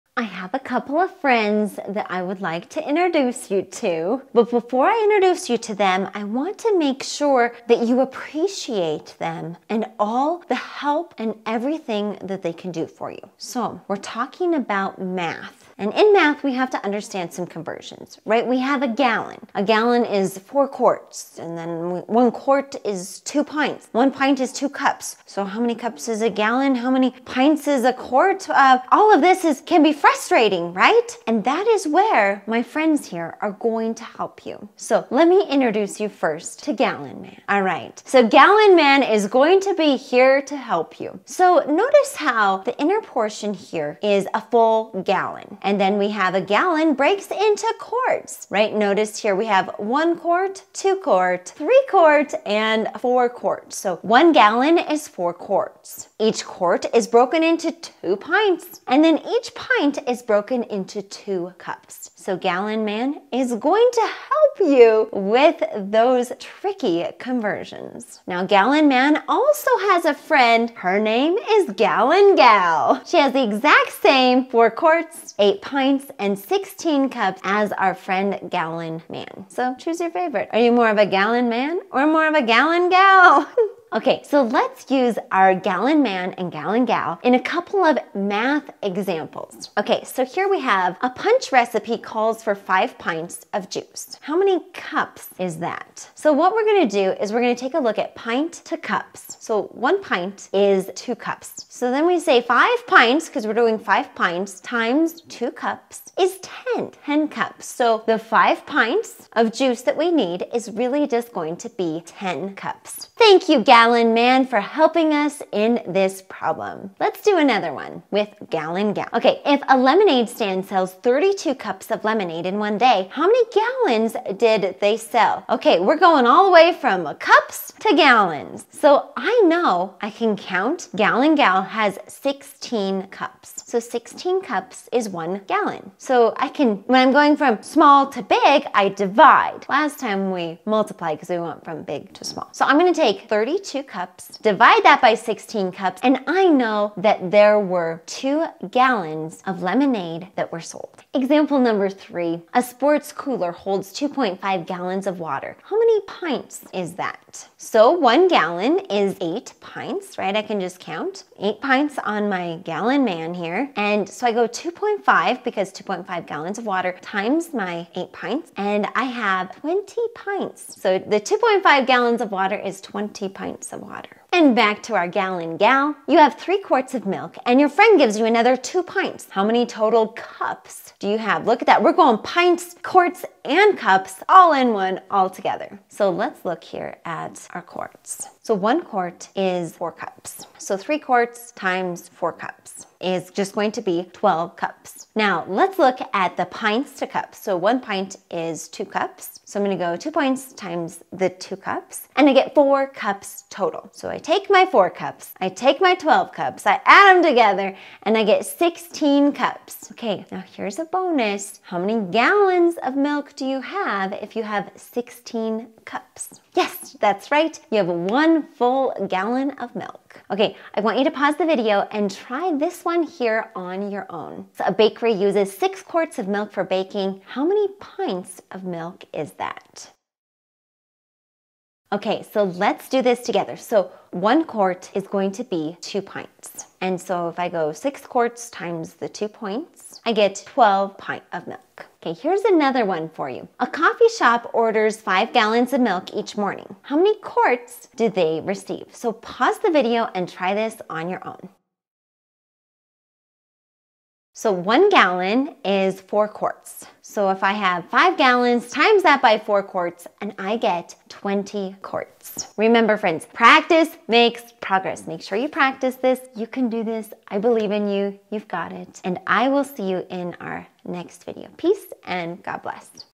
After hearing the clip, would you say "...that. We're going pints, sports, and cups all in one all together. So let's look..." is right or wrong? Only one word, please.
wrong.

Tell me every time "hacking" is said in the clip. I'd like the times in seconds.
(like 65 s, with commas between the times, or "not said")
not said.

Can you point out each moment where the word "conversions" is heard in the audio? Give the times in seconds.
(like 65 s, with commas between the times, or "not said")
17 s, 67 s.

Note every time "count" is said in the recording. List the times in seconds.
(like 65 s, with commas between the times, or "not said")
130 s, 160 s.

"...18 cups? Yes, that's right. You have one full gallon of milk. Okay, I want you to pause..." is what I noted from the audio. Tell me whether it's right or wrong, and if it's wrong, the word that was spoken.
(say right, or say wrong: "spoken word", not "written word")
wrong: "16", not "18".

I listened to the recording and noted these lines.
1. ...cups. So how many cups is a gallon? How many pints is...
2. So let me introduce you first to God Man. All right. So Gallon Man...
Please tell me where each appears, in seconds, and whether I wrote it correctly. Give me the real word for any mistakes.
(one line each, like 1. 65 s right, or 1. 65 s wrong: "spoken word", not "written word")
1. 24 s right
2. 34 s wrong: "Gallon", not "God".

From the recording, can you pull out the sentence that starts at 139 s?
Last time we multiplied because we went from big to small.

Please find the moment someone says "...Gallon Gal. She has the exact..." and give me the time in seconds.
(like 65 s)
71 s.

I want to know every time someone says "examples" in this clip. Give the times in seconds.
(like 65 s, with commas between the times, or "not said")
88 s, 151 s.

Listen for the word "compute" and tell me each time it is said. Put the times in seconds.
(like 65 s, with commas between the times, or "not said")
not said.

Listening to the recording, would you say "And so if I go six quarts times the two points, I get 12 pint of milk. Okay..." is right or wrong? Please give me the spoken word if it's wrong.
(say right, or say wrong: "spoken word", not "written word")
right.